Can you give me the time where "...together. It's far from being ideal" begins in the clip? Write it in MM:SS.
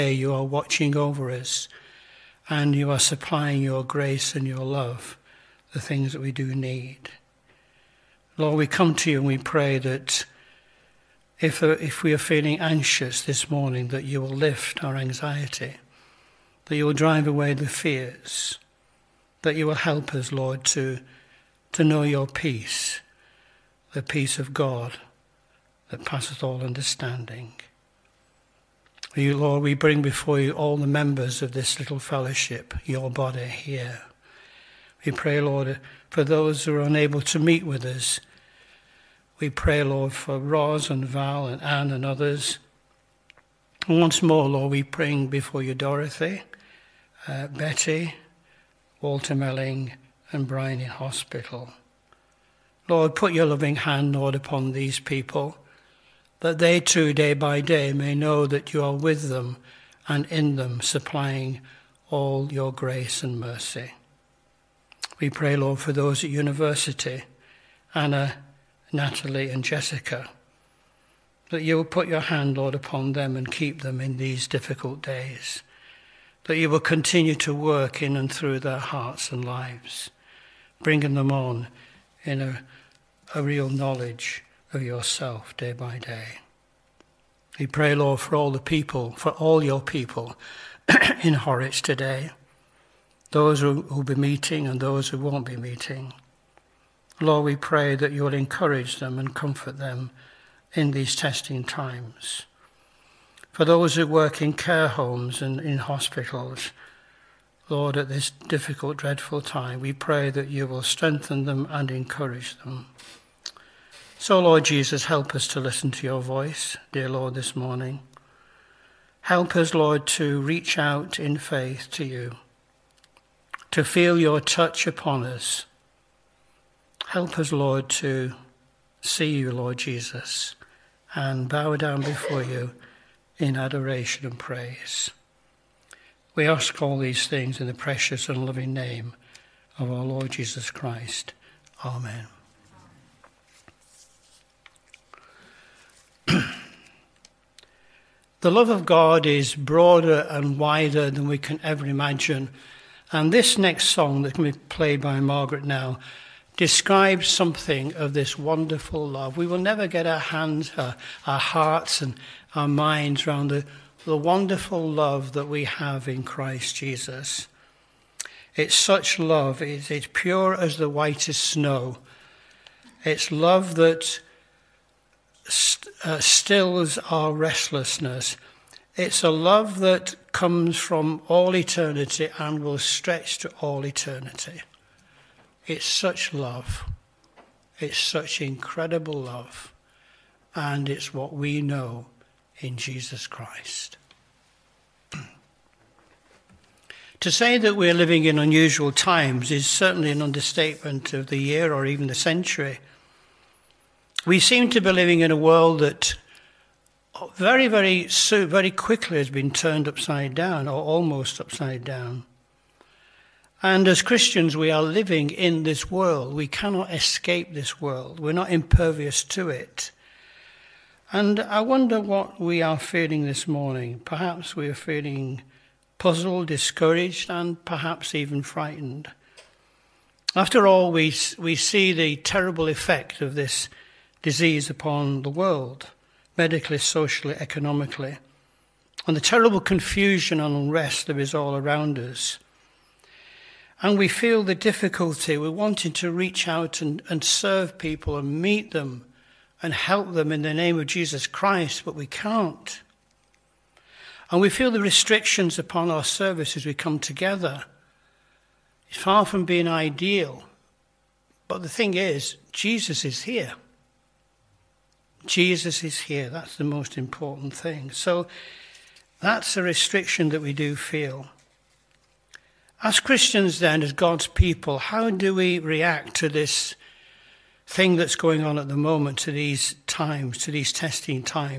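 04:16.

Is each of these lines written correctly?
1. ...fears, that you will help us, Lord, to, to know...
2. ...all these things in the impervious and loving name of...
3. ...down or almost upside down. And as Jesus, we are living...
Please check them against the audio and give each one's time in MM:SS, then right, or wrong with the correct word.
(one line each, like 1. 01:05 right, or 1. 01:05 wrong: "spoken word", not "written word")
1. 00:17 right
2. 02:16 wrong: "precious", not "impervious"
3. 03:30 wrong: "Christians", not "Jesus".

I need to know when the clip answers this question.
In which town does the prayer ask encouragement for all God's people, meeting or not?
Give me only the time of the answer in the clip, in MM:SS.
01:31.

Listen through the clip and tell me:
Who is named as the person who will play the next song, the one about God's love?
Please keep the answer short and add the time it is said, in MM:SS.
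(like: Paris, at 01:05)
Margaret, at 02:35.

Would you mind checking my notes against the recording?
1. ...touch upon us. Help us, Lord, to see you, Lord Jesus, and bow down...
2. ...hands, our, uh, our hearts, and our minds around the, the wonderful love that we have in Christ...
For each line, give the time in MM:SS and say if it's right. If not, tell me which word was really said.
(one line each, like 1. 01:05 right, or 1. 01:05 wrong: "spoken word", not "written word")
1. 02:04 right
2. 02:40 right.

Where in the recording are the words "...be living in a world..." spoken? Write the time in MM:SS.
03:24.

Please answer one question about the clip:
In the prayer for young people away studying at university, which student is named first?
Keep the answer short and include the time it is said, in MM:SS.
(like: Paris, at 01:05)
Anna, at 01:07.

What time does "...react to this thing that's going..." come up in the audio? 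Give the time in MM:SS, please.
04:35.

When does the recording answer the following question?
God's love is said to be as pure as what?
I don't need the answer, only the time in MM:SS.
02:50.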